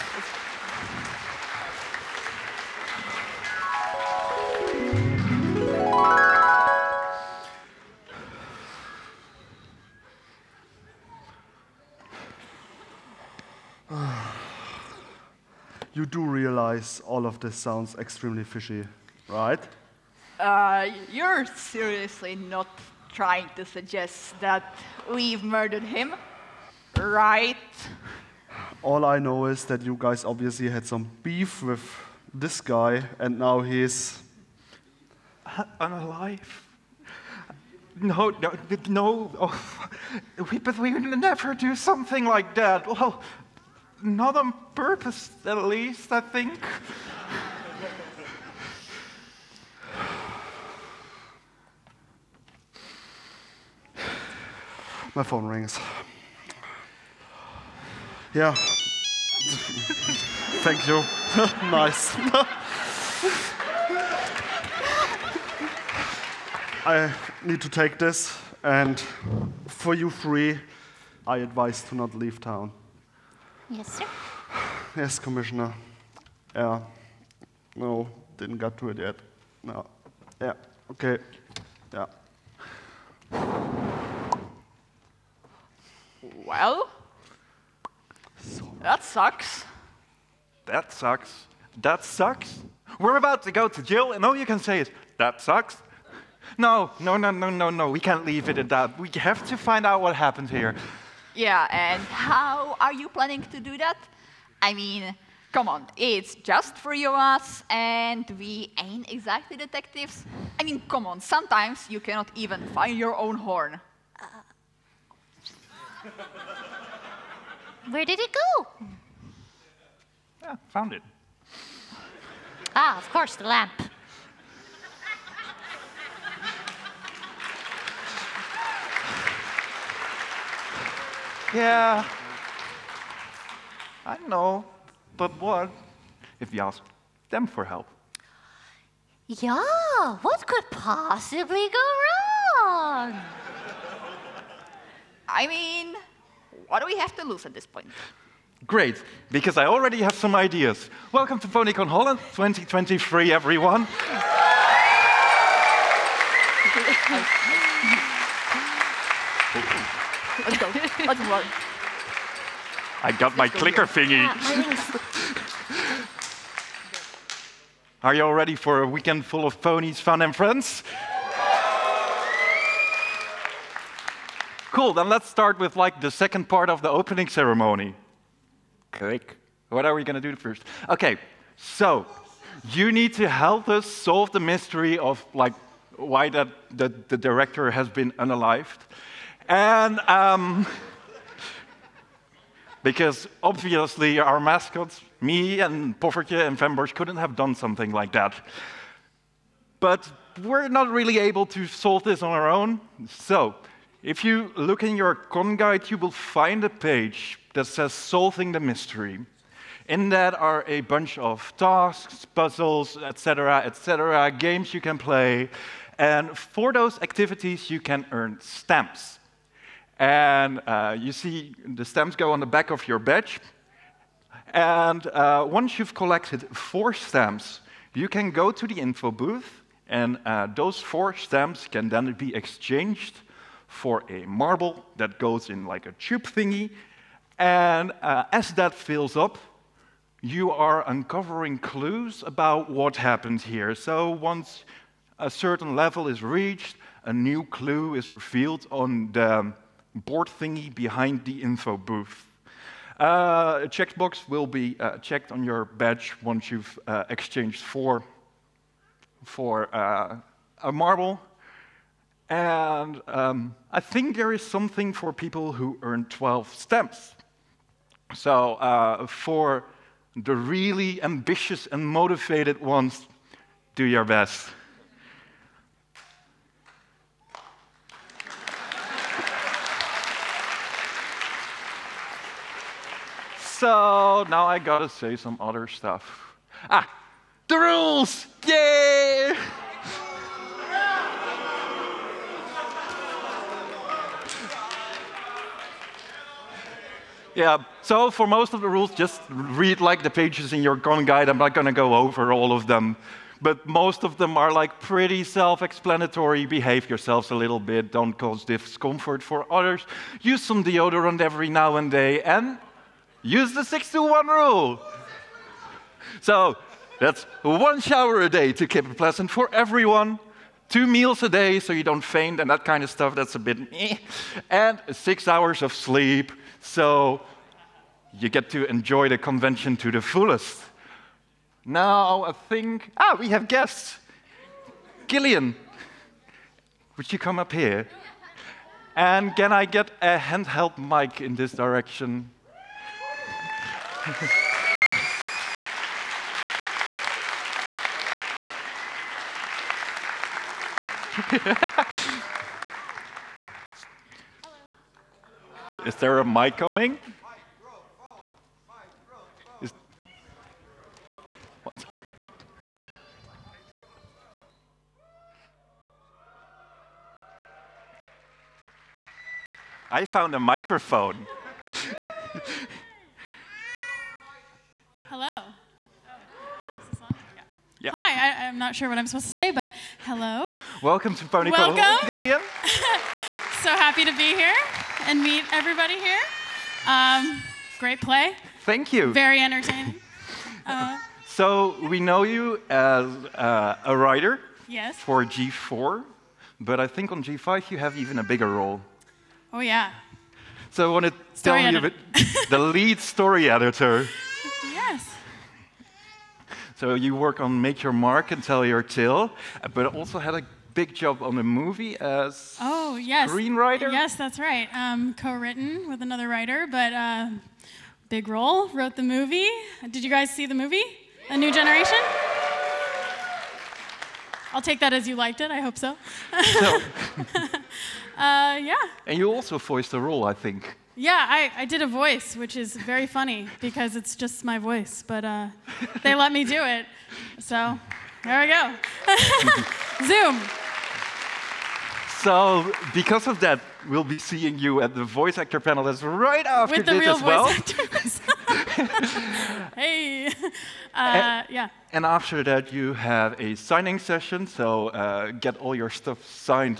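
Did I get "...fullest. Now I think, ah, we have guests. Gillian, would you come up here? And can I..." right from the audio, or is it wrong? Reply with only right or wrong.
right.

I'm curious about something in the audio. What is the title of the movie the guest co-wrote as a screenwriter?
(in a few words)
A New Generation.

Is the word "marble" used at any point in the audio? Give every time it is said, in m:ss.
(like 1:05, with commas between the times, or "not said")
3:54, 4:20.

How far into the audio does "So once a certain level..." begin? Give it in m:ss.
4:03.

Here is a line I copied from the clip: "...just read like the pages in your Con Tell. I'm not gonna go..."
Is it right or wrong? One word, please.
wrong.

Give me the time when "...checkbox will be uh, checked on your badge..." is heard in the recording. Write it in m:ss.
4:13.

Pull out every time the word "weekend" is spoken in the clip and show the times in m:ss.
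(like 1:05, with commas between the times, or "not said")
2:48.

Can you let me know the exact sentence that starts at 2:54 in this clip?
cool, then let's start with like the second part of the opening ceremony.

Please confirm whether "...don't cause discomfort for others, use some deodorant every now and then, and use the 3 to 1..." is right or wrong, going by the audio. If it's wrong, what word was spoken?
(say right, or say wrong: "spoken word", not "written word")
wrong: "6", not "3".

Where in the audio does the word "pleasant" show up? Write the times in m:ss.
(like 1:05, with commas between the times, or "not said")
5:18.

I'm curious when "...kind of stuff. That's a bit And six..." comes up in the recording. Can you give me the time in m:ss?
5:22.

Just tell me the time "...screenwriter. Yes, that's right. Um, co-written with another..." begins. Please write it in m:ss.
6:53.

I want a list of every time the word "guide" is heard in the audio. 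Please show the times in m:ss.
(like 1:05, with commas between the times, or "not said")
3:25, 5:01.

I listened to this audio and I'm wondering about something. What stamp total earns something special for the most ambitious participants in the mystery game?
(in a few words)
12.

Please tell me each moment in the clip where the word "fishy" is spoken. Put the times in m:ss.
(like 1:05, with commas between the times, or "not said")
0:18.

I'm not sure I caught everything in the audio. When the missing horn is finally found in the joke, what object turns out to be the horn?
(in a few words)
The lamp.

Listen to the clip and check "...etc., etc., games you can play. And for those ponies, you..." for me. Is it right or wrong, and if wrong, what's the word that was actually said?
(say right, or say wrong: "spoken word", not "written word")
wrong: "activities", not "ponies".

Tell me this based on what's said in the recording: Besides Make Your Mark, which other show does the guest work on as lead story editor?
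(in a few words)
Tell Your Tale.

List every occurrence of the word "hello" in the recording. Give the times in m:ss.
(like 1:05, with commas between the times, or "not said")
6:15, 6:20.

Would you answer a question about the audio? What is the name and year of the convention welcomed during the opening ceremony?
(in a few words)
PonyCon Holland 2023.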